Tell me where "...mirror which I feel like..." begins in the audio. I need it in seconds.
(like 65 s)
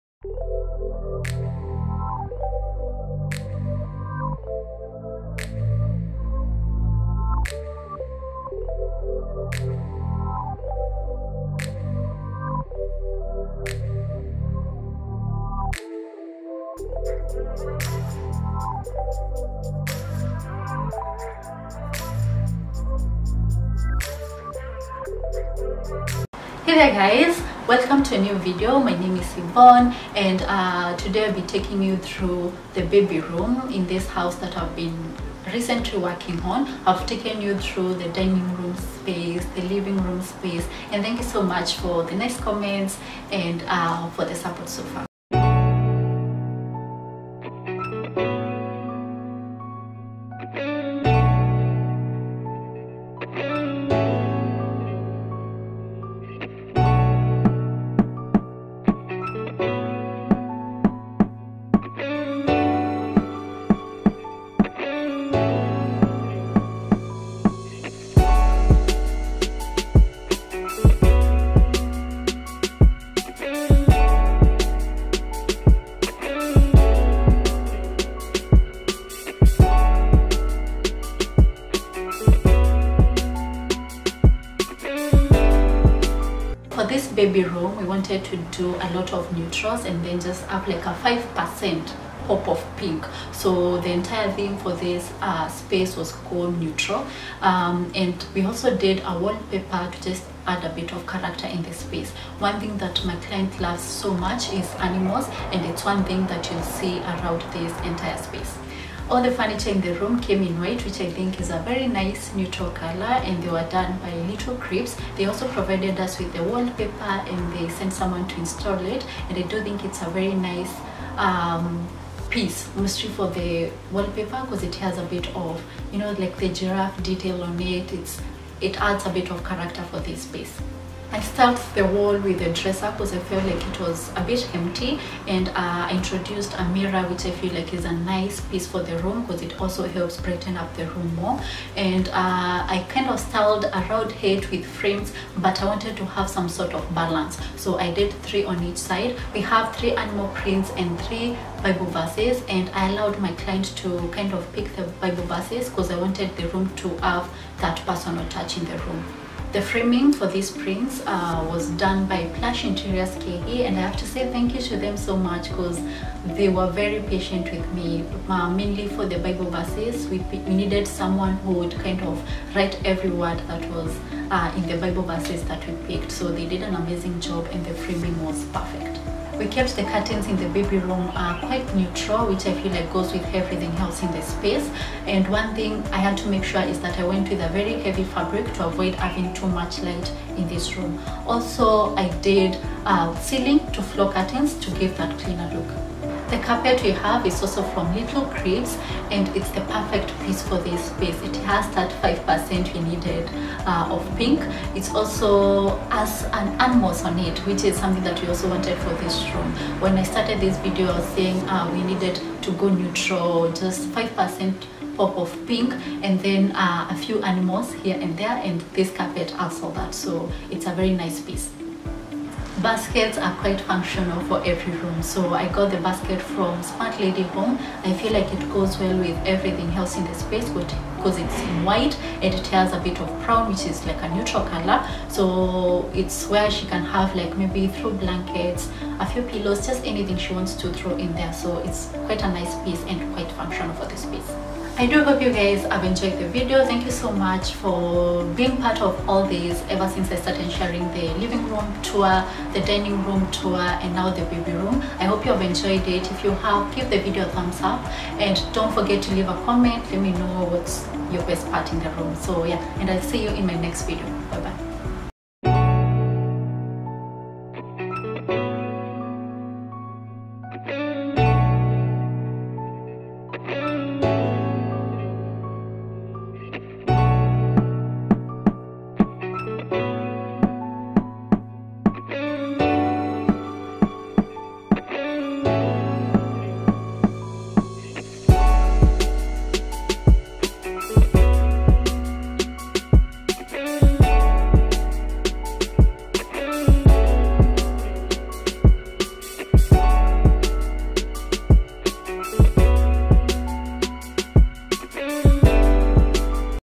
136 s.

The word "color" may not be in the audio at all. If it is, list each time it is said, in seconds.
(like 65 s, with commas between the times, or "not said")
112 s, 234 s.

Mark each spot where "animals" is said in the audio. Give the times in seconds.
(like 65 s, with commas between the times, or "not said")
104 s, 149 s, 206 s, 217 s.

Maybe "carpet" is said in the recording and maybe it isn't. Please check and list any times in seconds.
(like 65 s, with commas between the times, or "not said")
196 s, 218 s.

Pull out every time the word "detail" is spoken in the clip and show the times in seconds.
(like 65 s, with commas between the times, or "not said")
127 s.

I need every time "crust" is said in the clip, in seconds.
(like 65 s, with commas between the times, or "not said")
not said.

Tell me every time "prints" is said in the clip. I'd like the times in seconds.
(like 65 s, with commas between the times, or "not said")
150 s, 160 s.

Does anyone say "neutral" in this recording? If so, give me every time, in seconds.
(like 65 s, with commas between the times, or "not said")
89 s, 96 s, 112 s, 181 s, 212 s, 234 s.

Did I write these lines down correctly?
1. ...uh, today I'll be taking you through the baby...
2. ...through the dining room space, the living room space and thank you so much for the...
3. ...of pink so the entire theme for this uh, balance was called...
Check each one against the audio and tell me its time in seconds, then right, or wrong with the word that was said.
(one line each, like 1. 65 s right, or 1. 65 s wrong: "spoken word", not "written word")
1. 30 s right
2. 37 s right
3. 92 s wrong: "space", not "balance".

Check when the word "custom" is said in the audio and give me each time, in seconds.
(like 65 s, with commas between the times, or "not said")
not said.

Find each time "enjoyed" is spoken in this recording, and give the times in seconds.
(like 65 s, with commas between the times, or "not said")
245 s, 255 s.